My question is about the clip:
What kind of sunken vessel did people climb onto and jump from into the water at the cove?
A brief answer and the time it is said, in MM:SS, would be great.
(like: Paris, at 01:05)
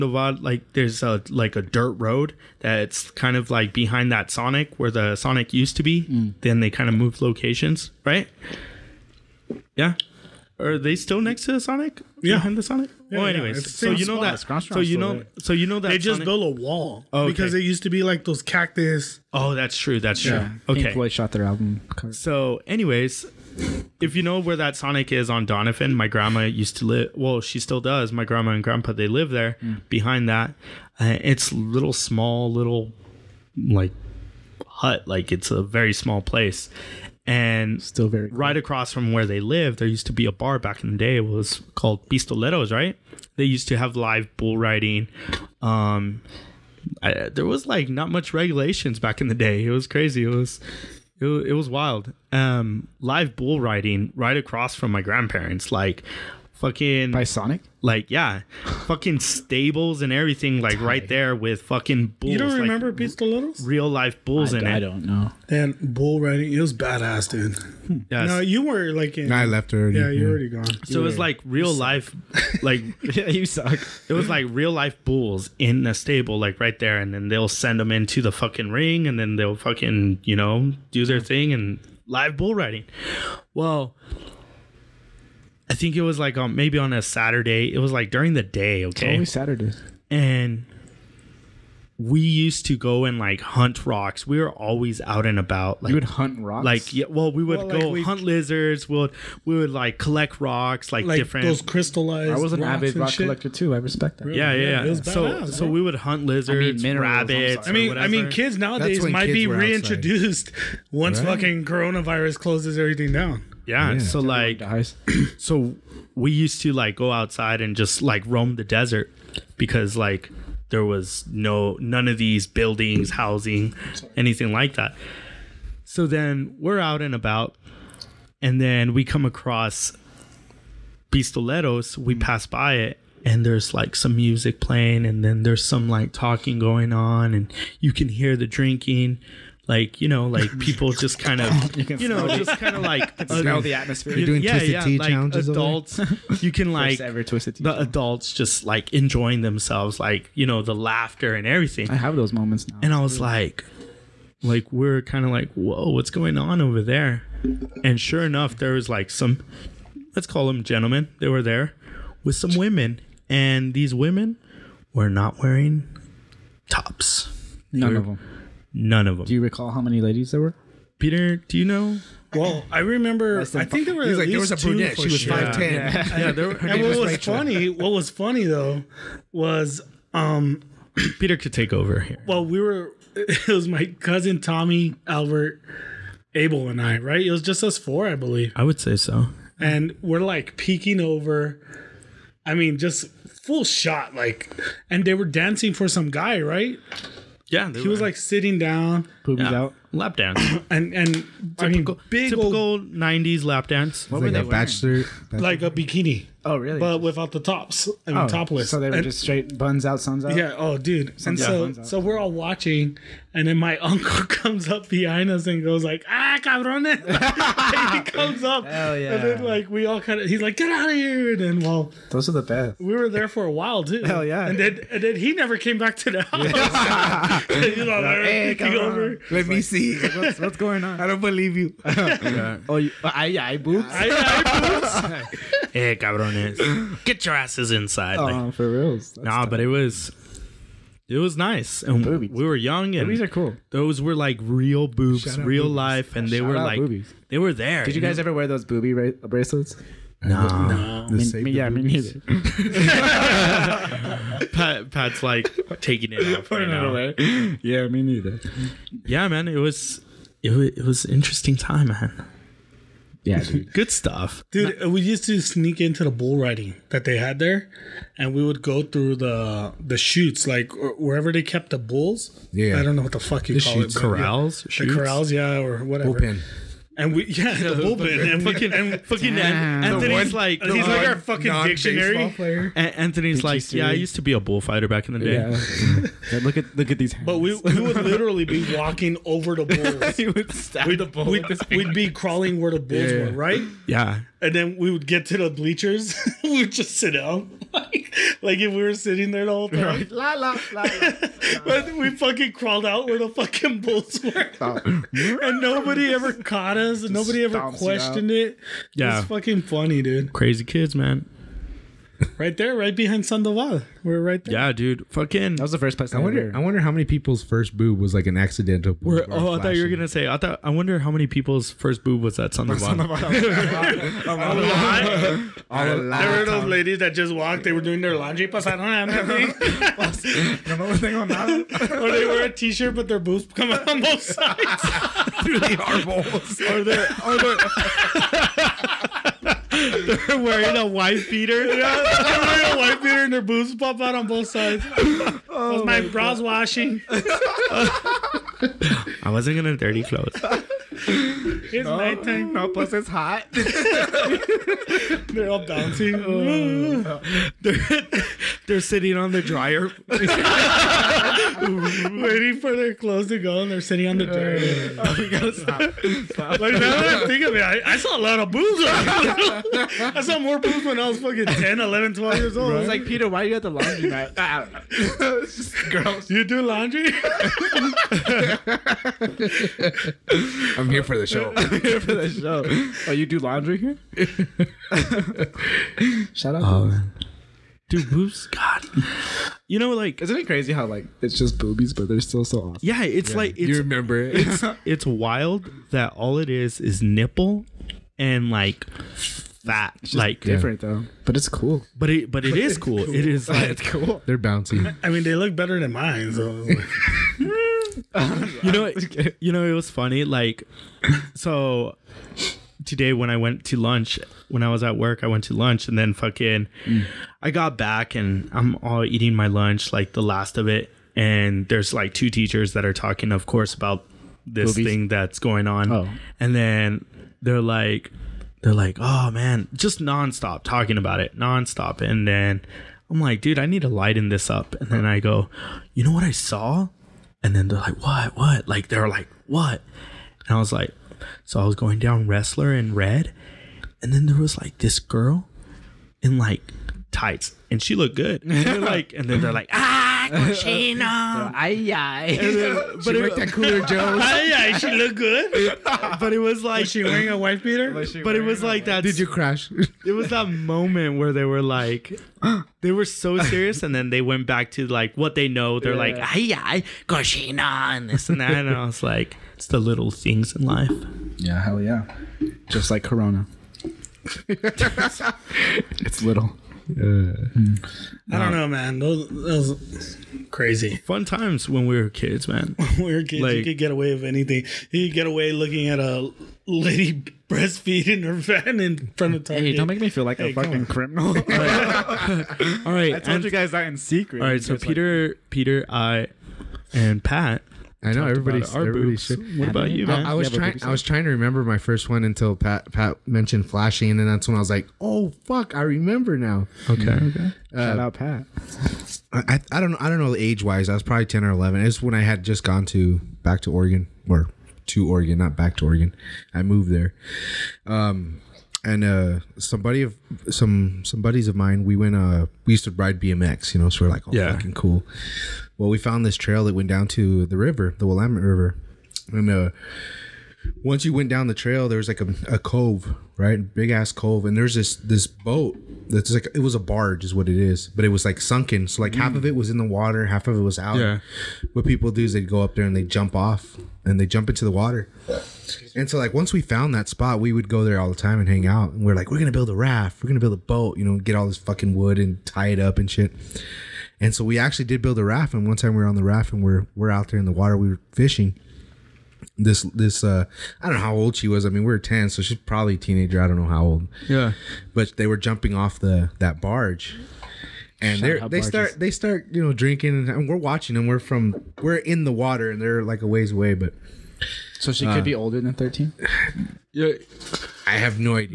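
A barge, at 08:56.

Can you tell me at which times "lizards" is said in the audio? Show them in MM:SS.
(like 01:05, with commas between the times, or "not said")
01:38, 01:46.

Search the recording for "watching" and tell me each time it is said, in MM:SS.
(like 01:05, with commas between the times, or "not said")
03:32, 09:30.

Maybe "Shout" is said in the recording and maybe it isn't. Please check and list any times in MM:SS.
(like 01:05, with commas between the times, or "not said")
04:05, 06:26, 08:27.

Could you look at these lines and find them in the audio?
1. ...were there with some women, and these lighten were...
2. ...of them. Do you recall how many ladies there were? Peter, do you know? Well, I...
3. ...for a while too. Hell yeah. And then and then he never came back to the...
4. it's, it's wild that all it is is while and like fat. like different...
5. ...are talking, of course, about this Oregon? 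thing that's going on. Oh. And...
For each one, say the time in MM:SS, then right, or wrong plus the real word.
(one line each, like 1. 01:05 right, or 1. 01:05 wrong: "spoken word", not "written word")
1. 02:41 wrong: "women", not "lighten"
2. 02:49 right
3. 03:43 right
4. 06:34 wrong: "nipple", not "while"
5. 07:02 wrong: "Movies", not "Oregon".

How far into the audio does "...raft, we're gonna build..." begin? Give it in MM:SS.
09:09.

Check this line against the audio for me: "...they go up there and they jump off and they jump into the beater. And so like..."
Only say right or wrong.
wrong.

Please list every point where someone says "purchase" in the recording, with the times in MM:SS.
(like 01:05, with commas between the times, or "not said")
not said.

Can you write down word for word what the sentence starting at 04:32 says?
Yeah, I don't know what the fuck you the call shoots, it.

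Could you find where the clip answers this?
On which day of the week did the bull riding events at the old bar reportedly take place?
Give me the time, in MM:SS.
01:26.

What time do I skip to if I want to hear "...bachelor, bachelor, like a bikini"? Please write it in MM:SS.
03:24.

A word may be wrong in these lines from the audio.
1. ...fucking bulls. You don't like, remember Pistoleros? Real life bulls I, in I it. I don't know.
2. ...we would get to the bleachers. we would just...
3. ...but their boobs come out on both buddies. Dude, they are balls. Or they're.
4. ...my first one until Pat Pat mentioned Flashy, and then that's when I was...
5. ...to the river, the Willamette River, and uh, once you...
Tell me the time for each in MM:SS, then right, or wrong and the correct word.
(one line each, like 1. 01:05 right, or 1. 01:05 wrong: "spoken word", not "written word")
1. 01:01 right
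2. 04:54 right
3. 05:32 wrong: "sides", not "buddies"
4. 08:21 right
5. 08:47 right.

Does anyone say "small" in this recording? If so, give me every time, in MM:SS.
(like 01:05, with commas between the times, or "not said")
00:31, 00:35.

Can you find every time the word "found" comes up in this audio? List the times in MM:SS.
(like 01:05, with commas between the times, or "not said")
08:45, 09:06.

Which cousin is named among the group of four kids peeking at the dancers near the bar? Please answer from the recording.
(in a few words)
Tommy.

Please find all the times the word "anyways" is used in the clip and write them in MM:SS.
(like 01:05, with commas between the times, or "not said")
00:13, 00:22.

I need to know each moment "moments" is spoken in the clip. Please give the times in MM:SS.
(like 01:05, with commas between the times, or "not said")
02:32, 07:40.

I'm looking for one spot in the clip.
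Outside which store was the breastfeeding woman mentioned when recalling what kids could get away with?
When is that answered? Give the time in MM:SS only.
08:08.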